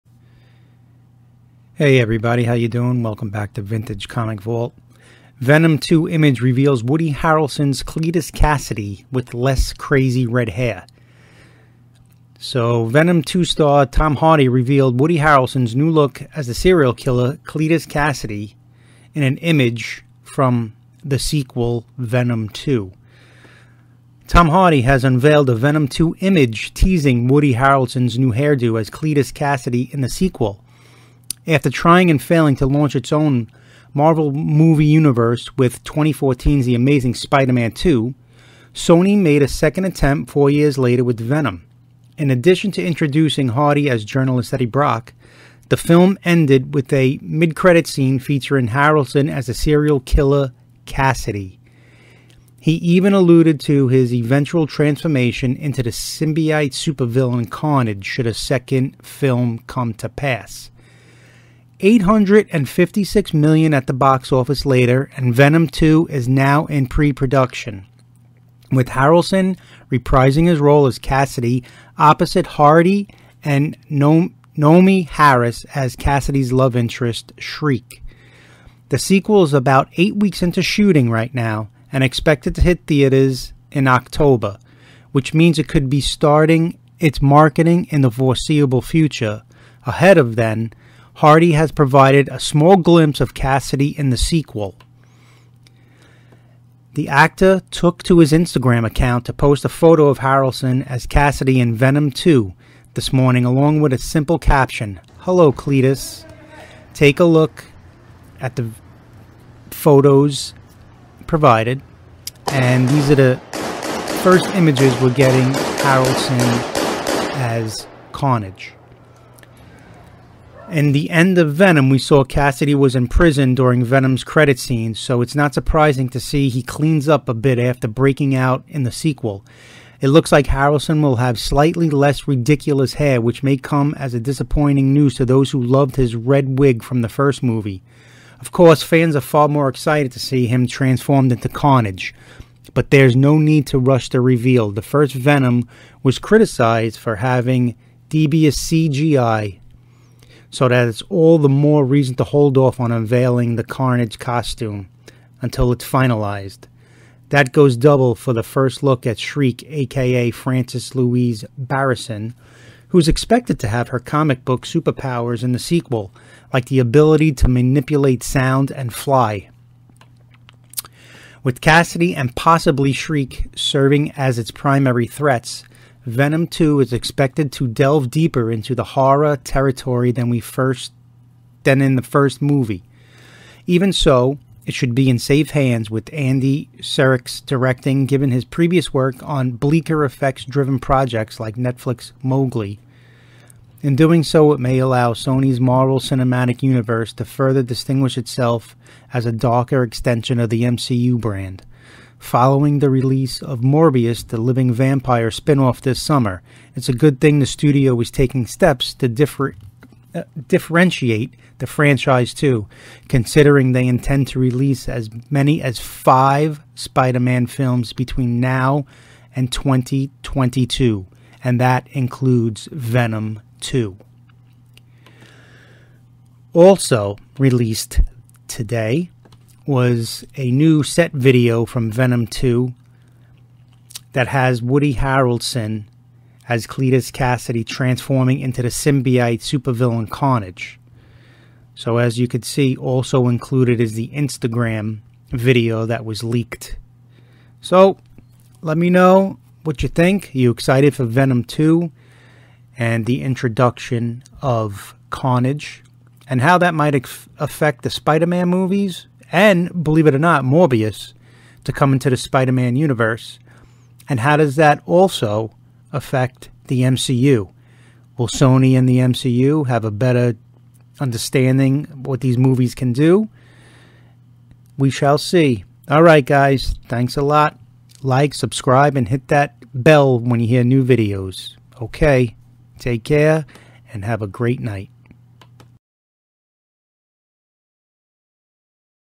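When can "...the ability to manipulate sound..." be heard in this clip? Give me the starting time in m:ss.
2:46.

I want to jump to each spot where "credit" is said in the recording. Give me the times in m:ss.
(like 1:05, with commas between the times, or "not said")
0:47, 2:04.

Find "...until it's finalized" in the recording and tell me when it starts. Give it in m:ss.
2:35.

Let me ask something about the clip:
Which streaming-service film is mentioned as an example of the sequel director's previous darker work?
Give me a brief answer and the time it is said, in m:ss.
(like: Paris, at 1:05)
Mowgli, at 3:12.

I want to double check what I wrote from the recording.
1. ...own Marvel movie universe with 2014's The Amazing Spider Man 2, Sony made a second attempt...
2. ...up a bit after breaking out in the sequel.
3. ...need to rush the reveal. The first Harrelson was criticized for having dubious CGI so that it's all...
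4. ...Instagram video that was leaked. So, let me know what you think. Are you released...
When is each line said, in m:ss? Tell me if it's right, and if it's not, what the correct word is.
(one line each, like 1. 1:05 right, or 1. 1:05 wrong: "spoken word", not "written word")
1. 0:33 right
2. 2:07 right
3. 2:23 wrong: "Venom", not "Harrelson"
4. 4:04 wrong: "excited", not "released".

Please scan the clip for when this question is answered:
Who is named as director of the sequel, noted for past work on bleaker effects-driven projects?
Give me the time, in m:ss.
3:06.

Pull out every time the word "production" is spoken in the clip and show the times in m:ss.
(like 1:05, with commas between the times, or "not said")
1:06.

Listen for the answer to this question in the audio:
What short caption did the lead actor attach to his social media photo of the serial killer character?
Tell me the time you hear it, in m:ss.
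1:45.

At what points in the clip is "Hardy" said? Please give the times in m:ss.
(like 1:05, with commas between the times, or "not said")
0:14, 0:24, 0:43, 1:12, 1:31.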